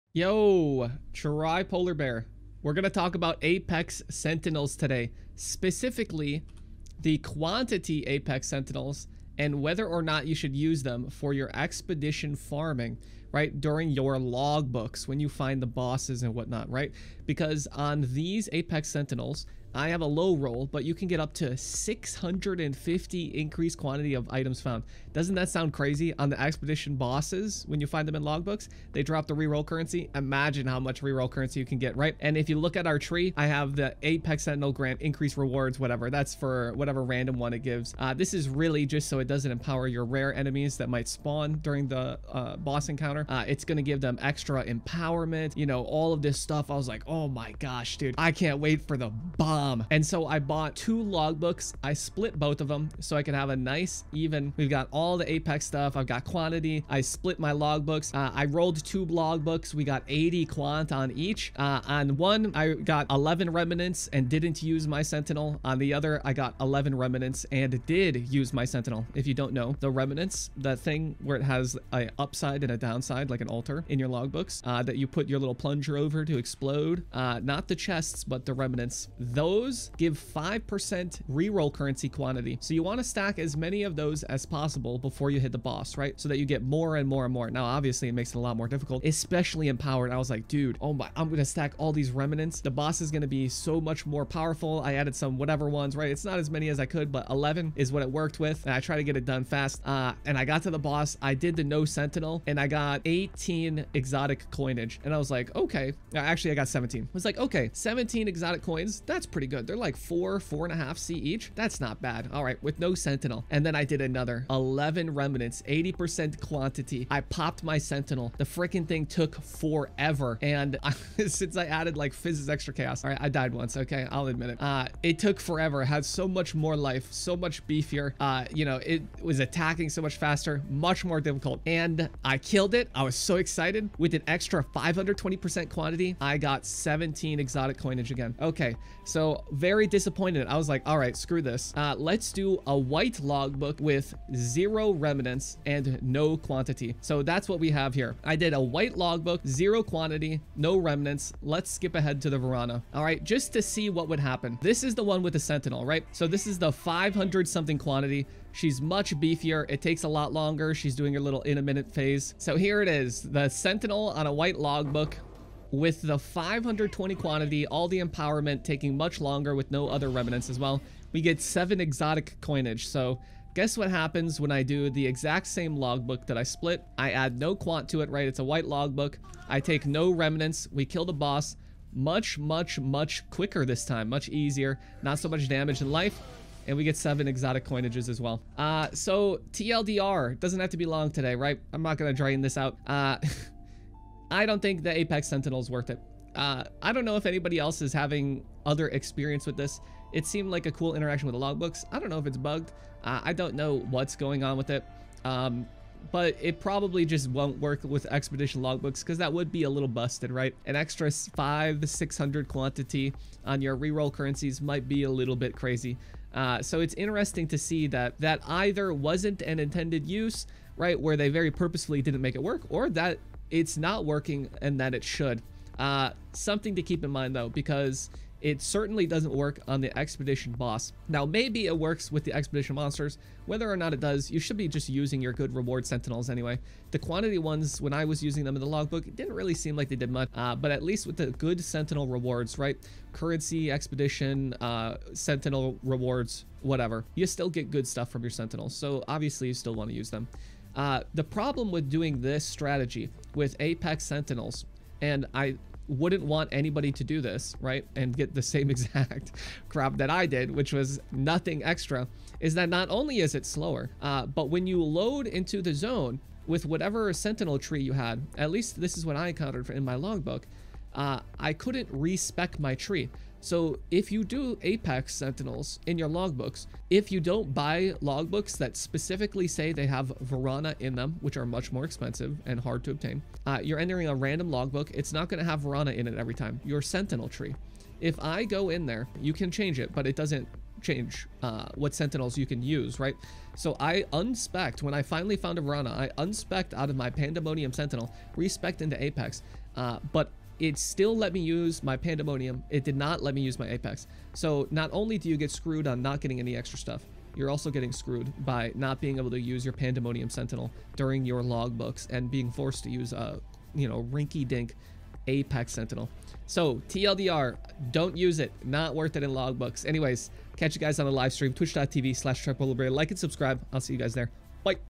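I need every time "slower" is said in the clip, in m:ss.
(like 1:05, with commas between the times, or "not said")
4:23.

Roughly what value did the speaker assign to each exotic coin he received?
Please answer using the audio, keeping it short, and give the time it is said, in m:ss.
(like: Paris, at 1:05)
four and a half C, at 1:50.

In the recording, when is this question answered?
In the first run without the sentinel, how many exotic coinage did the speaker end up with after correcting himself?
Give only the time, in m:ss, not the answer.
1:47.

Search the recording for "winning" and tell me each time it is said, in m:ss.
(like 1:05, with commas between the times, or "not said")
not said.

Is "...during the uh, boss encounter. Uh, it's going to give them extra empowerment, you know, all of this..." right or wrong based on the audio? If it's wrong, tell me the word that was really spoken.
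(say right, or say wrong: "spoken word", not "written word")
right.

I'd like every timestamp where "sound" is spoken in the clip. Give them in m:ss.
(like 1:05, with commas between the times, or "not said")
0:25.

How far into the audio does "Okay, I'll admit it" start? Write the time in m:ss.
2:03.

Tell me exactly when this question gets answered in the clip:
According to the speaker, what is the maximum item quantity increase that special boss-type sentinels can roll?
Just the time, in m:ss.
0:21.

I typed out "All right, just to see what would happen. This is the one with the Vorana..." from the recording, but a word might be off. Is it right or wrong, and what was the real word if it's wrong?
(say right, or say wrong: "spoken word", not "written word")
wrong: "Sentinel", not "Vorana".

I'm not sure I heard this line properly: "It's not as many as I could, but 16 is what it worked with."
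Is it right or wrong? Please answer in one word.
wrong.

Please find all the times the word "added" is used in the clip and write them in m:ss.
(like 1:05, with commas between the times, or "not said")
1:34, 2:01.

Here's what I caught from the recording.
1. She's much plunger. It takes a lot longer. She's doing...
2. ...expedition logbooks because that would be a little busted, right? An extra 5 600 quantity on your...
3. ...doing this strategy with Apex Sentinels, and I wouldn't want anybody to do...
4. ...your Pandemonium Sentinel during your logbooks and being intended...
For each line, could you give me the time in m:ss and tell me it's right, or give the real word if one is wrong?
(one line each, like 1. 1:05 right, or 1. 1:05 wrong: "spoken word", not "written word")
1. 2:38 wrong: "beefier", not "plunger"
2. 3:28 right
3. 4:11 right
4. 5:09 wrong: "forced", not "intended".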